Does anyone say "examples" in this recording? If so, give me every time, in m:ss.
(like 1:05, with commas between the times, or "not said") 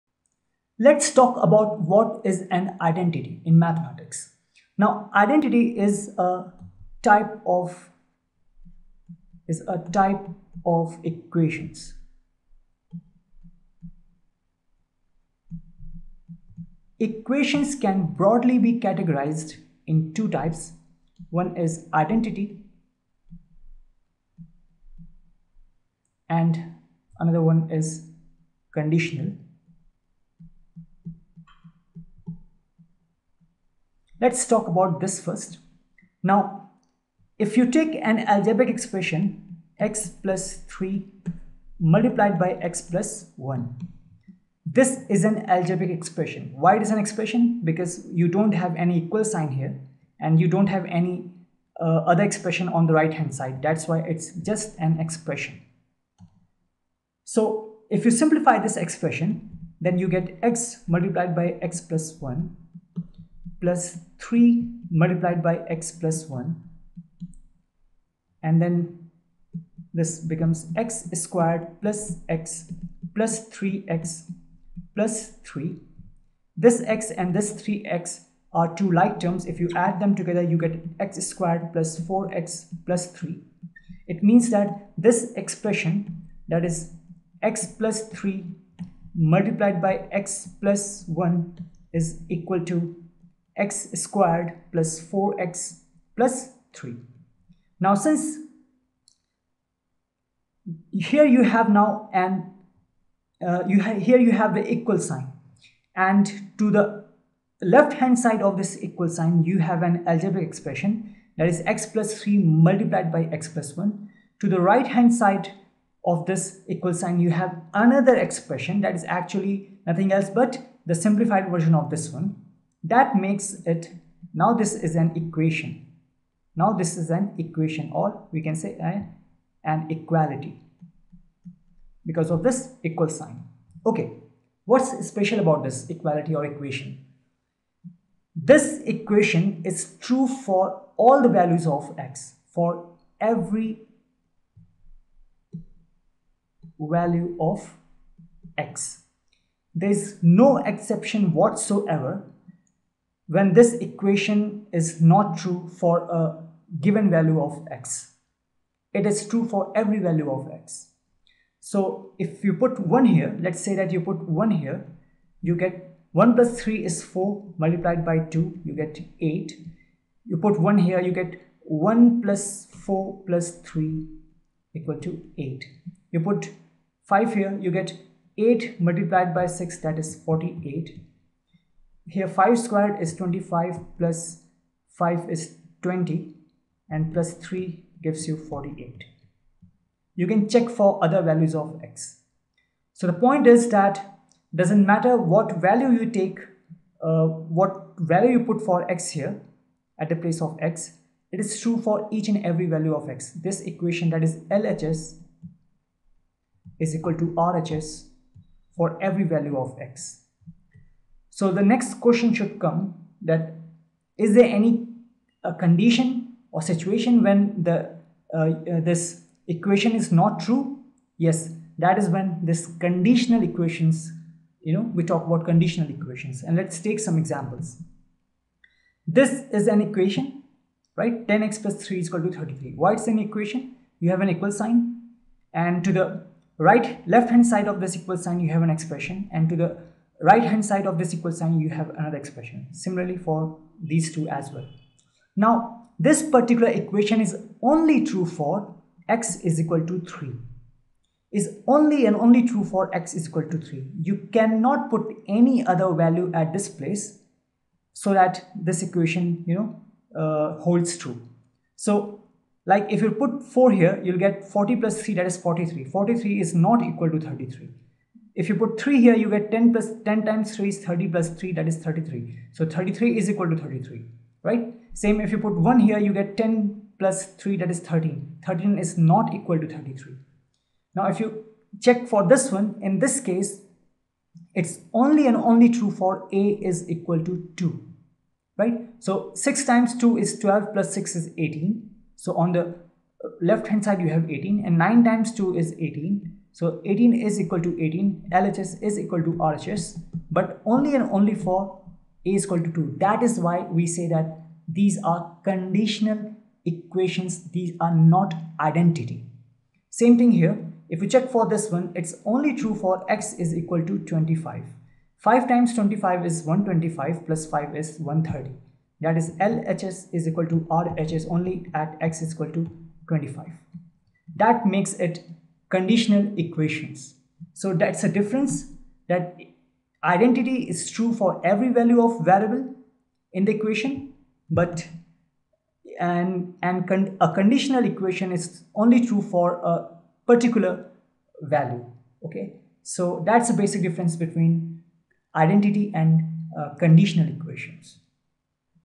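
3:47.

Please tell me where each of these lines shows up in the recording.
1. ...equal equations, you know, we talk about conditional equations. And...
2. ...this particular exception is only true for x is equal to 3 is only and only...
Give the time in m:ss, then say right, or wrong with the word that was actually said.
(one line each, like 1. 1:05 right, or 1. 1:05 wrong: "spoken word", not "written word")
1. 3:42 wrong: "conditional", not "equal"
2. 4:06 wrong: "equation", not "exception".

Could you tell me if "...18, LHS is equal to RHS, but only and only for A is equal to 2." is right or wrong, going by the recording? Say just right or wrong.
right.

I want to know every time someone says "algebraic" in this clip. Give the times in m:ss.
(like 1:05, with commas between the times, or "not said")
0:38, 0:45, 1:50.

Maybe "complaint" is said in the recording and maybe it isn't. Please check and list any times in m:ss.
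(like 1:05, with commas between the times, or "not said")
not said.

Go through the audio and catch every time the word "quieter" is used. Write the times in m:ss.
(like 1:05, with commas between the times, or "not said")
not said.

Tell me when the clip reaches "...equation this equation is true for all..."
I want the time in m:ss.
2:16.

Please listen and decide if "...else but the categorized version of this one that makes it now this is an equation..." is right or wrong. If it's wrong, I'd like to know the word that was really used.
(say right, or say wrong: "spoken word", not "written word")
wrong: "simplified", not "categorized".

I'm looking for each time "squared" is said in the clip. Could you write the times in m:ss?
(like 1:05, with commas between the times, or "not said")
1:11, 1:21, 1:33, 3:02.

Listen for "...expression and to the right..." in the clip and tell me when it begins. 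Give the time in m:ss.
3:58.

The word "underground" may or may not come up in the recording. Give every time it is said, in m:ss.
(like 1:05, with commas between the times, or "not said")
not said.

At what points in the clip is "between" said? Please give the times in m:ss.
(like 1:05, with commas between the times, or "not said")
5:44.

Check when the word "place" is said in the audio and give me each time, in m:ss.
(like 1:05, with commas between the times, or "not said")
3:20, 4:16.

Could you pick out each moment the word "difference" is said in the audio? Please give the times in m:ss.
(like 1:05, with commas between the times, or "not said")
5:28, 5:43.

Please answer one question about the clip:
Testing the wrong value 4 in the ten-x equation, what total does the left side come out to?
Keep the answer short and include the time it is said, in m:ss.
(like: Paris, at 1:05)
43, at 4:24.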